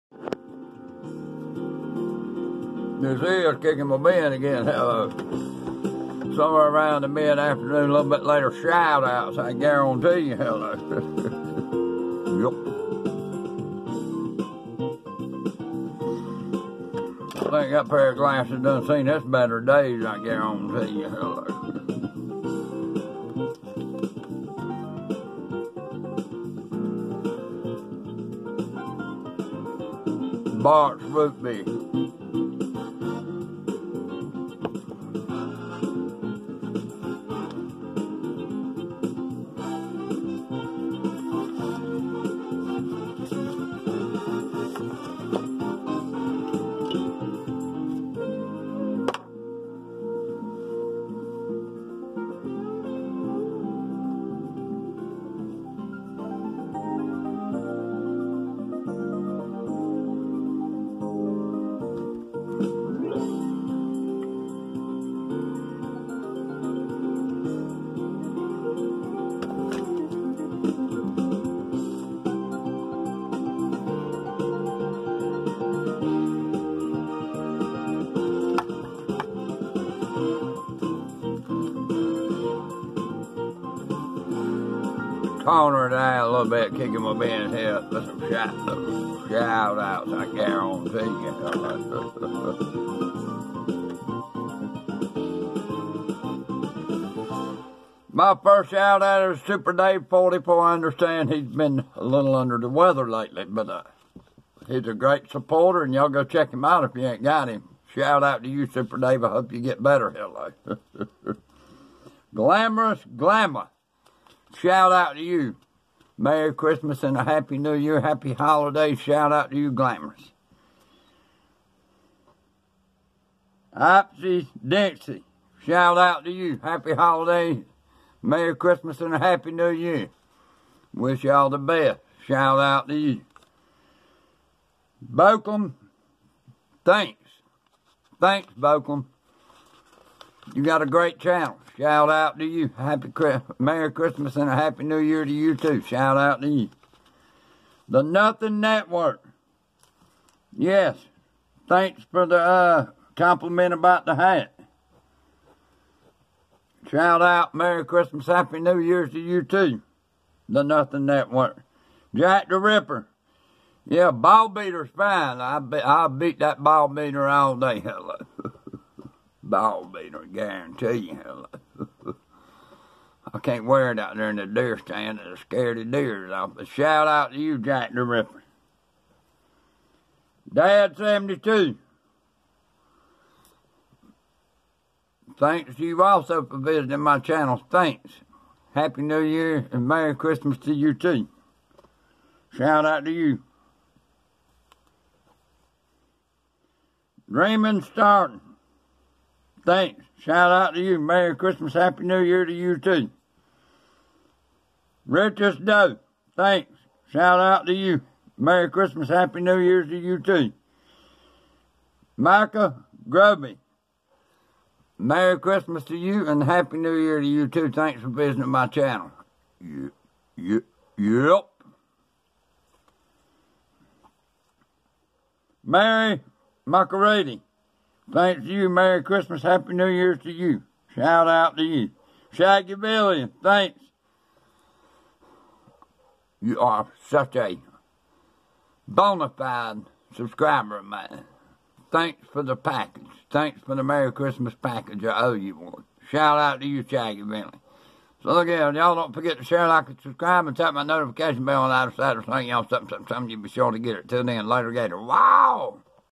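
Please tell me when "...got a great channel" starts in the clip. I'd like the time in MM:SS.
02:20.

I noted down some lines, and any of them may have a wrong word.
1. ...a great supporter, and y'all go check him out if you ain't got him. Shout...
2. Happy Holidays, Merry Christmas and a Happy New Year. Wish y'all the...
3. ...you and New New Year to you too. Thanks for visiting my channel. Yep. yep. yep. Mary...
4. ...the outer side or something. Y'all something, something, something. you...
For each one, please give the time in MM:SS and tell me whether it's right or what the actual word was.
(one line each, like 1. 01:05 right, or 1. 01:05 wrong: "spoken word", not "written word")
1. 01:44 right
2. 02:06 right
3. 03:35 wrong: "Happy", not "New"
4. 04:11 right.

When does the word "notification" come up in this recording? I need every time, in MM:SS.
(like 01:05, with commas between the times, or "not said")
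04:10.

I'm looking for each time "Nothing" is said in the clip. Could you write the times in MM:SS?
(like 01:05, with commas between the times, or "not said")
02:28, 02:40.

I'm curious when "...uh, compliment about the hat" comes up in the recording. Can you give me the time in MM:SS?
02:32.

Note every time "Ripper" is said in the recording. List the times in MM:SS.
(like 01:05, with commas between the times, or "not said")
02:42, 02:58.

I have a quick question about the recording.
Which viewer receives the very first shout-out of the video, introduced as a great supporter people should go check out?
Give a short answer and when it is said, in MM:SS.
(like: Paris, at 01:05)
Super Dave 44, at 01:39.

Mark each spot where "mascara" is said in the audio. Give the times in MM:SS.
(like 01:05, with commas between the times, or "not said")
not said.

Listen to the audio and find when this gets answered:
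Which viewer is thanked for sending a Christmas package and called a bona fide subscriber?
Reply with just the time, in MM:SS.
03:52.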